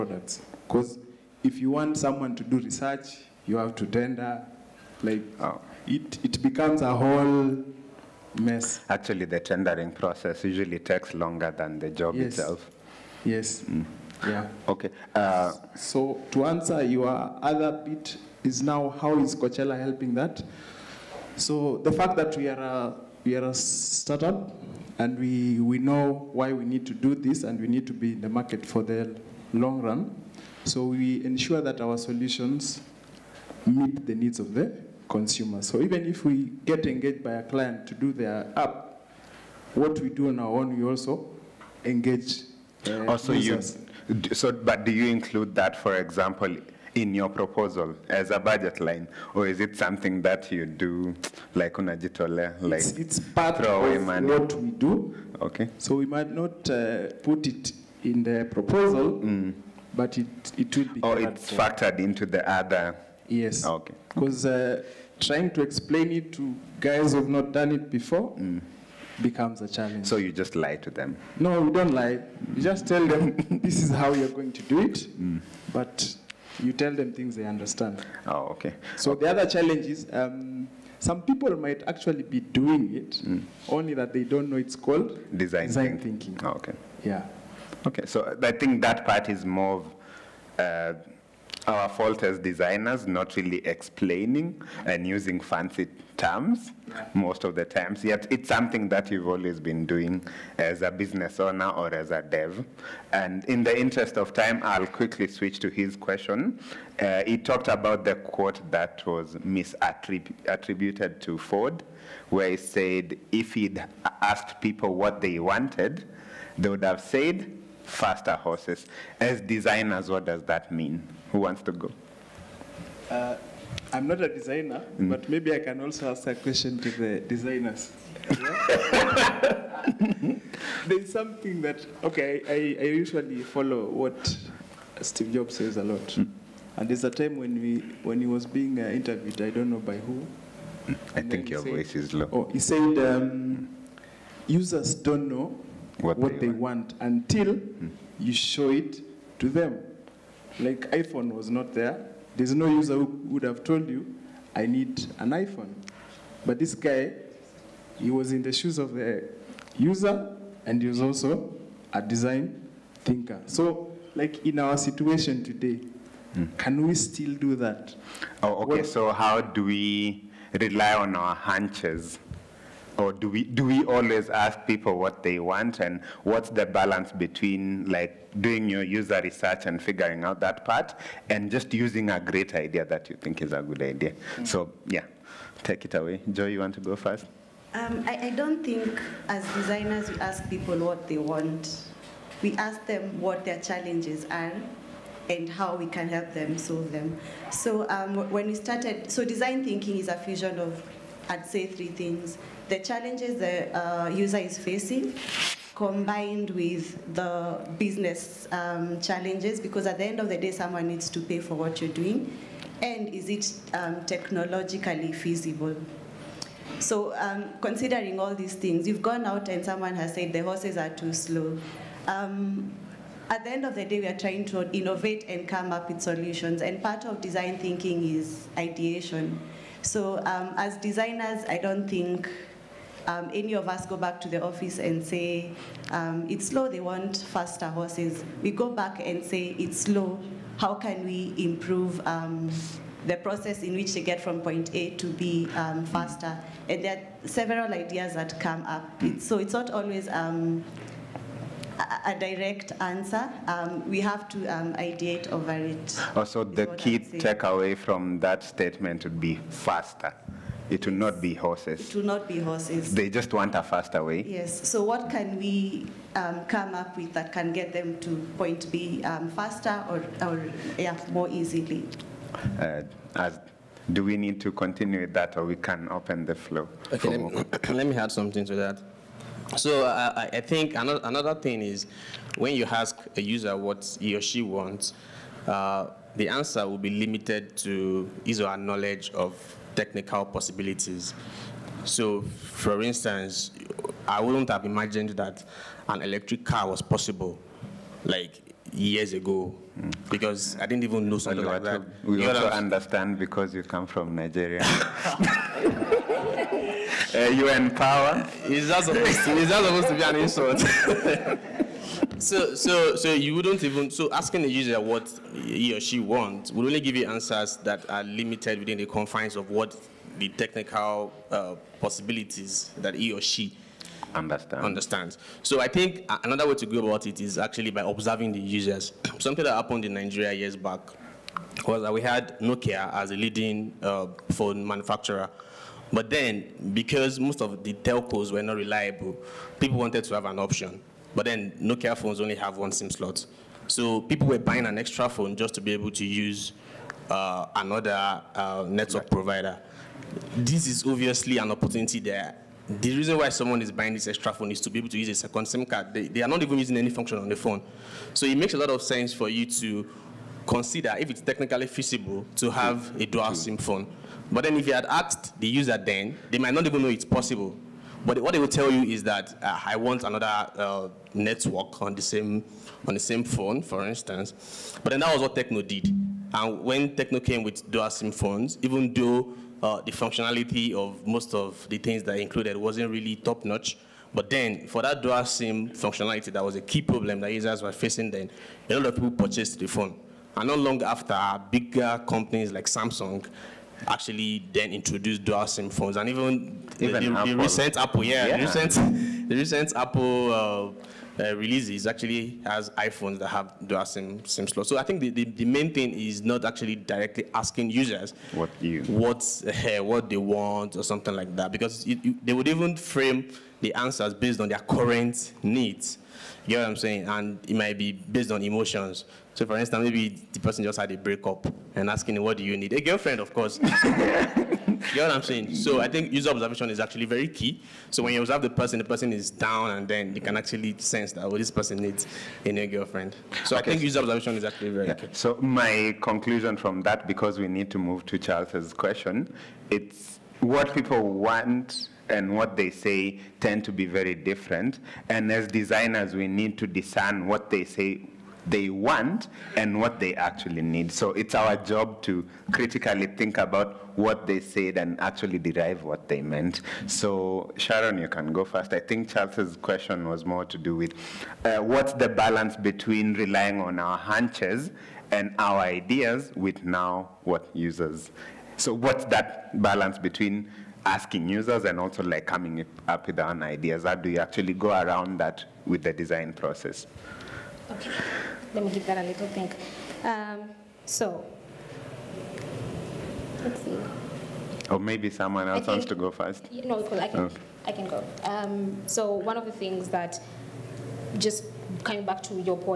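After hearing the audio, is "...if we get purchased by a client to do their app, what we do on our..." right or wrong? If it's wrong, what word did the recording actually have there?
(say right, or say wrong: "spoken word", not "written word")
wrong: "engaged", not "purchased".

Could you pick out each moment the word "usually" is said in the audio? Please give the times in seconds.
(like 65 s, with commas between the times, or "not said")
10 s, 132 s.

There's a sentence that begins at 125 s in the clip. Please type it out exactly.
but maybe I can also ask a question to the designers.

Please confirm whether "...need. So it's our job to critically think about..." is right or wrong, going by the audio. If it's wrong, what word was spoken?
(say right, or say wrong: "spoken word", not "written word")
right.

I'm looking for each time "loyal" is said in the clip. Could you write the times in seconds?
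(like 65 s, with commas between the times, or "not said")
not said.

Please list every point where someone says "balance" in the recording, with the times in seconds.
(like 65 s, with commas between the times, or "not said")
176 s, 462 s, 469 s.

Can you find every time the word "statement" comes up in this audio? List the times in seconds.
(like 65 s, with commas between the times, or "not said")
258 s.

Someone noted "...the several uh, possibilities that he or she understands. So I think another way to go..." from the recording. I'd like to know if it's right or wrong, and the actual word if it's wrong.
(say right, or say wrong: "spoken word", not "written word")
wrong: "technical", not "several".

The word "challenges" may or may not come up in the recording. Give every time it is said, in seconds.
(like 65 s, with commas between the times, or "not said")
69 s, 79 s, 193 s, 202 s, 208 s.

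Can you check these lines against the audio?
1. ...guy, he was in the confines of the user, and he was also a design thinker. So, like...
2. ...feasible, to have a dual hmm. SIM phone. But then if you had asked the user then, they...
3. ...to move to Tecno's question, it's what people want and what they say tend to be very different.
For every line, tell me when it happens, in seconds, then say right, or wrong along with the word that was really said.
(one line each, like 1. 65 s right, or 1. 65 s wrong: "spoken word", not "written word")
1. 156 s wrong: "shoes", not "confines"
2. 361 s right
3. 437 s wrong: "Charles", not "Tecno".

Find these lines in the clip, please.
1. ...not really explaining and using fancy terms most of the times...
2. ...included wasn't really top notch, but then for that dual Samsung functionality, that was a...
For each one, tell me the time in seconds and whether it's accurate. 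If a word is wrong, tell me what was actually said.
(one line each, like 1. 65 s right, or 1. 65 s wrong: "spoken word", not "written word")
1. 93 s right
2. 382 s wrong: "SIM", not "Samsung".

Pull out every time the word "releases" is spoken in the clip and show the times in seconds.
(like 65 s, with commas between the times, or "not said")
401 s.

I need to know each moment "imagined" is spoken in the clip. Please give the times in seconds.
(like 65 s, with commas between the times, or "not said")
294 s.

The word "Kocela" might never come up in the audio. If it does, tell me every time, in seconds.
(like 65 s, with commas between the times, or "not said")
19 s.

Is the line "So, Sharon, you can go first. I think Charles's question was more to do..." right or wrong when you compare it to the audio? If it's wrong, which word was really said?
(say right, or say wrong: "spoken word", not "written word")
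right.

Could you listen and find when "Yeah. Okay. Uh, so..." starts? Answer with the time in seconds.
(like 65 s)
14 s.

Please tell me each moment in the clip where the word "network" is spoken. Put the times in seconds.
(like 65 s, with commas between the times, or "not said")
348 s, 371 s.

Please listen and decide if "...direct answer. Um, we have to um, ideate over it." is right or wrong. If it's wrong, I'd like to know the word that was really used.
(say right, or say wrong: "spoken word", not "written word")
right.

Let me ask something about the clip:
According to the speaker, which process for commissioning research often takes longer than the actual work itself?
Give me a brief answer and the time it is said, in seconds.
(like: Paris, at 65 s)
tendering process, at 9 s.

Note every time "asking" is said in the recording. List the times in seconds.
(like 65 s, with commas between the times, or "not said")
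314 s, 407 s, 421 s, 470 s.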